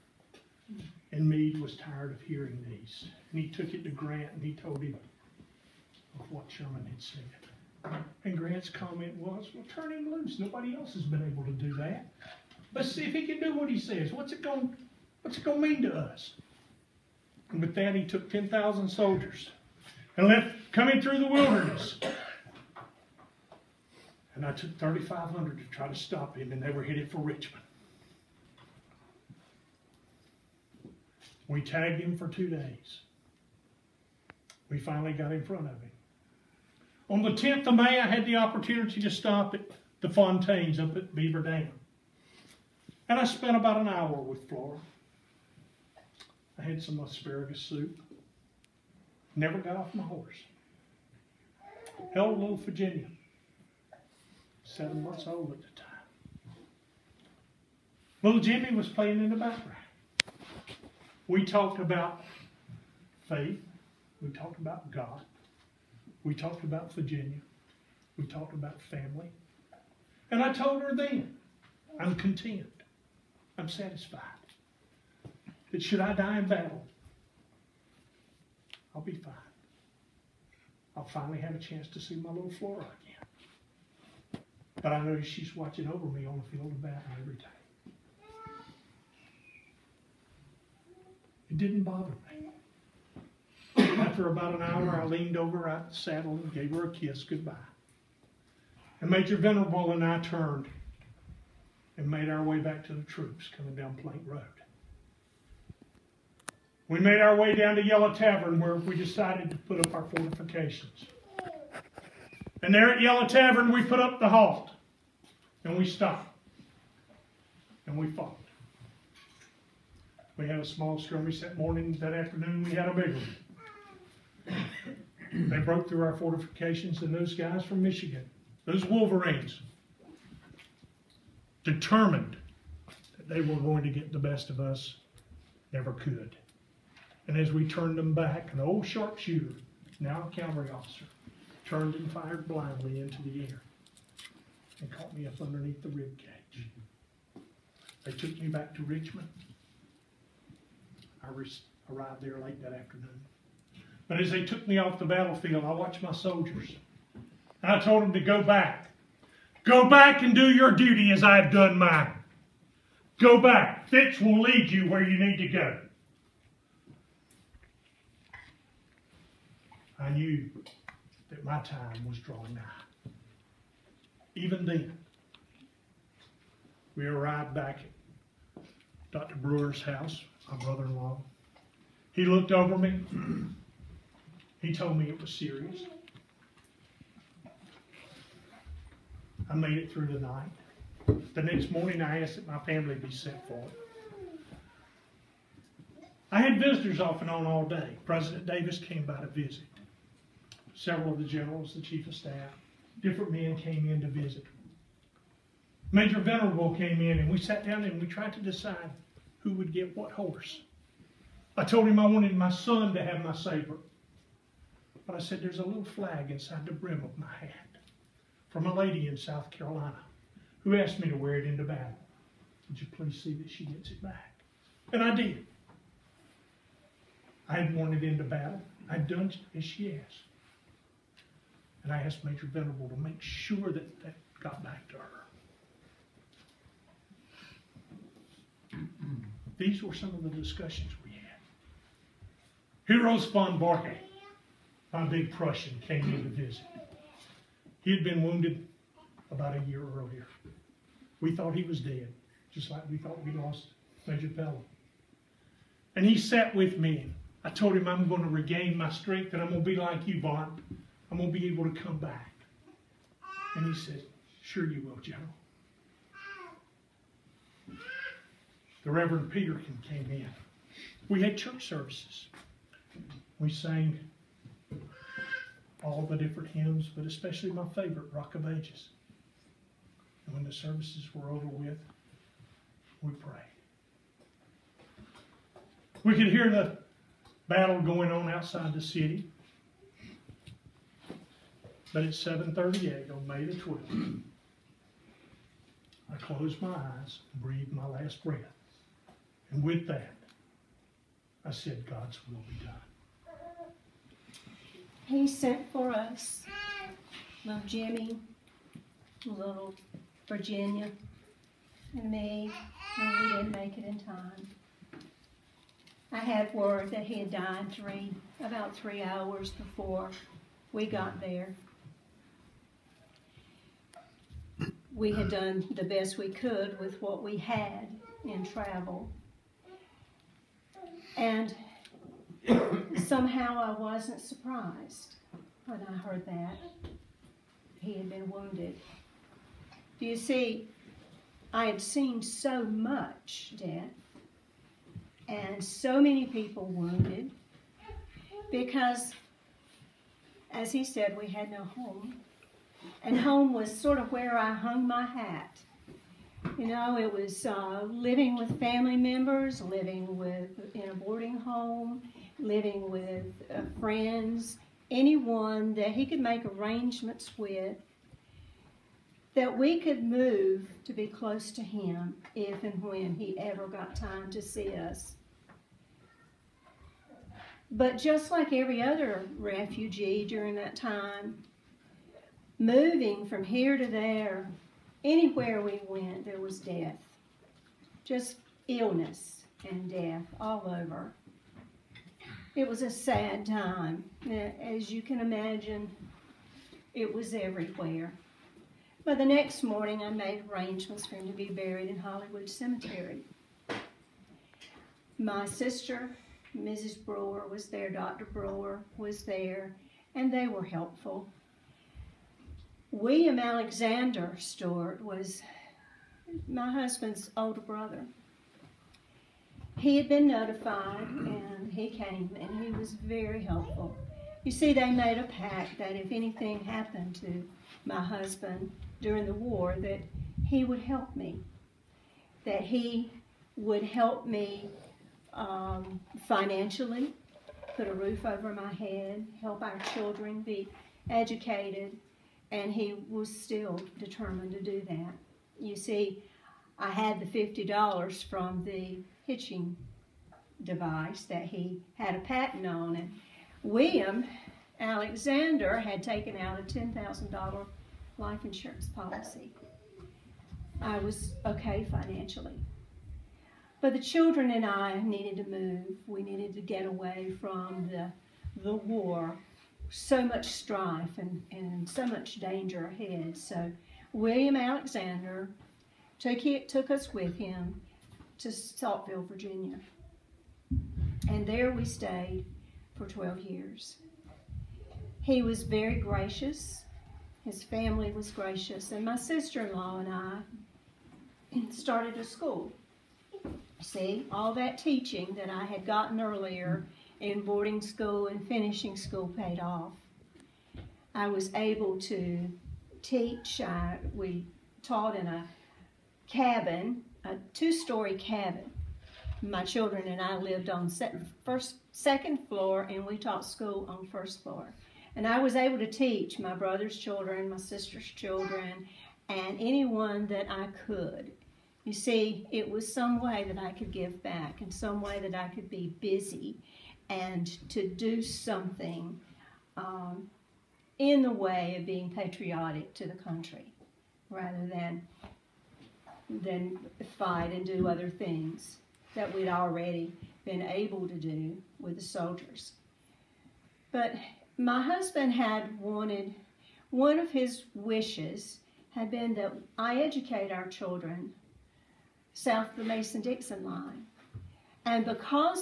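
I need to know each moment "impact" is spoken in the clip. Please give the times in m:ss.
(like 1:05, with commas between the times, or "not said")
not said.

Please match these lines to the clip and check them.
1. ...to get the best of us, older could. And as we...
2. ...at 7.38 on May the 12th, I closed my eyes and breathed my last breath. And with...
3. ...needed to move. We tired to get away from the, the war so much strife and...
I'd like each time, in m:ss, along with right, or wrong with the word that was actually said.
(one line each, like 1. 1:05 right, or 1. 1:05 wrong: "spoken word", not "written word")
1. 2:13 wrong: "never", not "older"
2. 4:52 right
3. 7:45 wrong: "needed", not "tired".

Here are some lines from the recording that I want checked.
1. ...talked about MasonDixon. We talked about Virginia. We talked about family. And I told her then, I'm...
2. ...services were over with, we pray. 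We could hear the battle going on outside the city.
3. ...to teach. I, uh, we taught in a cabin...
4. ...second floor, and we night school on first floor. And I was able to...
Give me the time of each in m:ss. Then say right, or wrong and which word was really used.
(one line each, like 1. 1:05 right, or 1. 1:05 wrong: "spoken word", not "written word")
1. 1:04 wrong: "God", not "MasonDixon"
2. 4:40 right
3. 8:22 right
4. 8:31 wrong: "taught", not "night".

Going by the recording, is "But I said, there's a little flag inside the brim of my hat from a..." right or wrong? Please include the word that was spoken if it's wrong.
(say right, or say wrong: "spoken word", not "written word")
right.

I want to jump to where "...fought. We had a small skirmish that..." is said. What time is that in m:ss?
1:58.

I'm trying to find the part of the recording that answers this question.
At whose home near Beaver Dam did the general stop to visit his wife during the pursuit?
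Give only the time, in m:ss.
0:40.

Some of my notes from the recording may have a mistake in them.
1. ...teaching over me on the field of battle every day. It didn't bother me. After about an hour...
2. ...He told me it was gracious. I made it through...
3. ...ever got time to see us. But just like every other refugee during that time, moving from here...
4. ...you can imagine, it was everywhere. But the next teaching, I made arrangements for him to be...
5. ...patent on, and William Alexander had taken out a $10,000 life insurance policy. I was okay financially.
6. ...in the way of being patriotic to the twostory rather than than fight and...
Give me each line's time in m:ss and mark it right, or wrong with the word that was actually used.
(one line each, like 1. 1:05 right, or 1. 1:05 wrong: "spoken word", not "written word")
1. 1:25 wrong: "watching", not "teaching"
2. 3:04 wrong: "serious", not "gracious"
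3. 6:13 right
4. 6:34 wrong: "morning", not "teaching"
5. 7:32 right
6. 8:50 wrong: "country", not "twostory".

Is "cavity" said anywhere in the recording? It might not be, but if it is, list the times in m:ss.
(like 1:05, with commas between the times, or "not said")
not said.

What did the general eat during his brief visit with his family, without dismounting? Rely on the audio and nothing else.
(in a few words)
asparagus soup.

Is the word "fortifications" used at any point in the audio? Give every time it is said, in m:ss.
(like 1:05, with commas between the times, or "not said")
1:50, 2:06.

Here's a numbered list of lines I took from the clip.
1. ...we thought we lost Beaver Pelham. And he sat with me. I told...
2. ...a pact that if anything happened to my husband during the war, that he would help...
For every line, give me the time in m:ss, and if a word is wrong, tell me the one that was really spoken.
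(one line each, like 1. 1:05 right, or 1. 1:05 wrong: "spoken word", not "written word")
1. 4:12 wrong: "Major", not "Beaver"
2. 7:05 right.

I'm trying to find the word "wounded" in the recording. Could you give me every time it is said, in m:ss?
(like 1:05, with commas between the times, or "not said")
4:08, 5:38, 5:46.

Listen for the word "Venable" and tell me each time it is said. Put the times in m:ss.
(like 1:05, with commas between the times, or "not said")
1:39, 3:26, 3:52.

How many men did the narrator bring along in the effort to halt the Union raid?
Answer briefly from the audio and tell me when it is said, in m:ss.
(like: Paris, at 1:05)
3,500, at 0:24.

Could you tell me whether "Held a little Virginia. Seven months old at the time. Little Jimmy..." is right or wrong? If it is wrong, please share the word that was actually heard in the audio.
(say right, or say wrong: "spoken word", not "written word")
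right.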